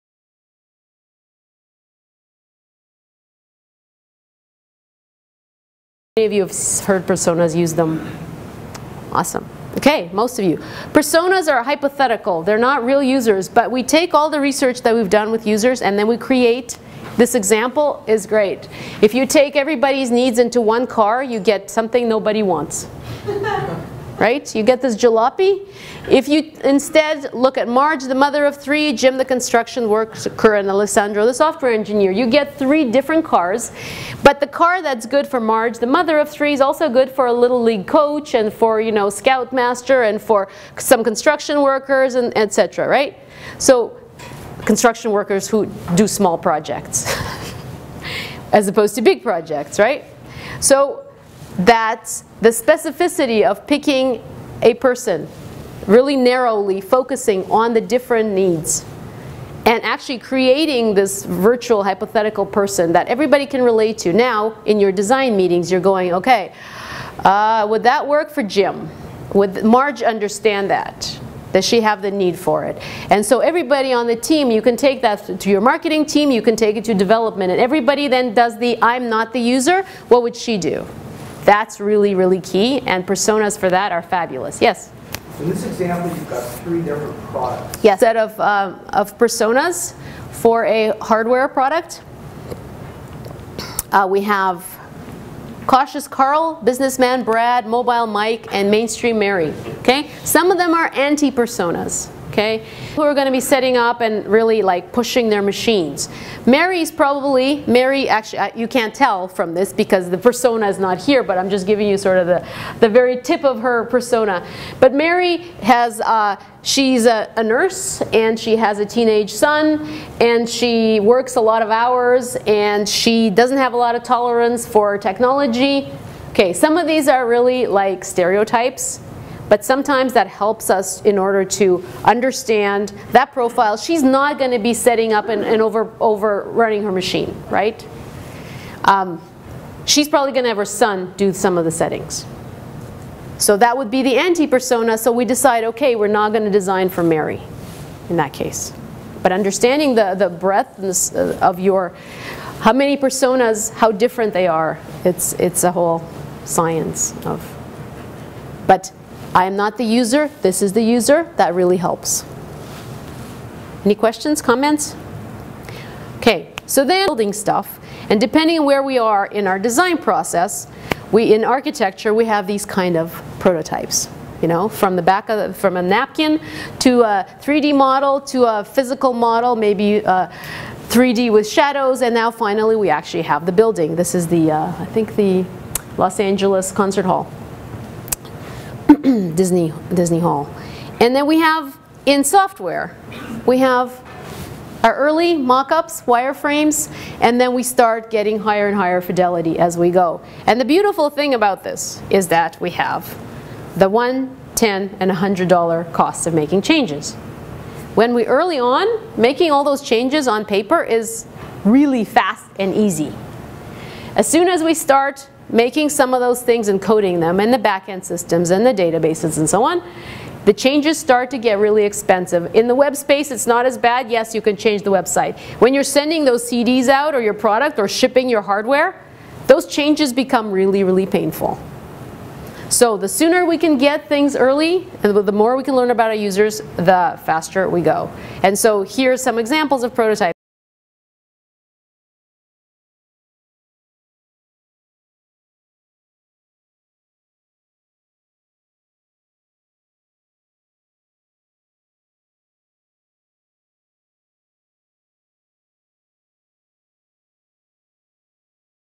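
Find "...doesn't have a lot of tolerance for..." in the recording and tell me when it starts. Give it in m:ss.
2:03.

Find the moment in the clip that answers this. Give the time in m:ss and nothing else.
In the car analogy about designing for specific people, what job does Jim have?
0:29.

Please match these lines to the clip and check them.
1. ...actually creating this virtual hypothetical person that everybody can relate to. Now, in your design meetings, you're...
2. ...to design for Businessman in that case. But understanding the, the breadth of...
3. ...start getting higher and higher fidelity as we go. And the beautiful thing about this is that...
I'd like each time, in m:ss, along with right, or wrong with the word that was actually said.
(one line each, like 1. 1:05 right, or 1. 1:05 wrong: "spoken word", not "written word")
1. 0:59 right
2. 2:26 wrong: "Mary", not "Businessman"
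3. 3:17 right.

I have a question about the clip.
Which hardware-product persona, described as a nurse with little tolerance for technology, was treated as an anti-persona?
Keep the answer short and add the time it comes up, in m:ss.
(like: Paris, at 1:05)
Mainstream Mary, at 1:38.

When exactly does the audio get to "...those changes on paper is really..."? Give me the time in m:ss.
3:29.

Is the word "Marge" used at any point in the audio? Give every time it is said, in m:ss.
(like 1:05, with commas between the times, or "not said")
0:27, 0:35, 1:09.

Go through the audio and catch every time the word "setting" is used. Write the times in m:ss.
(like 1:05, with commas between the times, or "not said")
1:43, 2:14, 2:21.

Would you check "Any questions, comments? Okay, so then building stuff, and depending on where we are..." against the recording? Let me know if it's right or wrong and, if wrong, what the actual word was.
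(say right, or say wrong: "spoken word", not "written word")
right.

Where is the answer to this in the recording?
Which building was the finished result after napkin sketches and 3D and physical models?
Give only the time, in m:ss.
3:09.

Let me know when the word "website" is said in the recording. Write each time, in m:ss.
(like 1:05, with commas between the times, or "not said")
3:44.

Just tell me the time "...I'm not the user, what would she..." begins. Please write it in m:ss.
1:18.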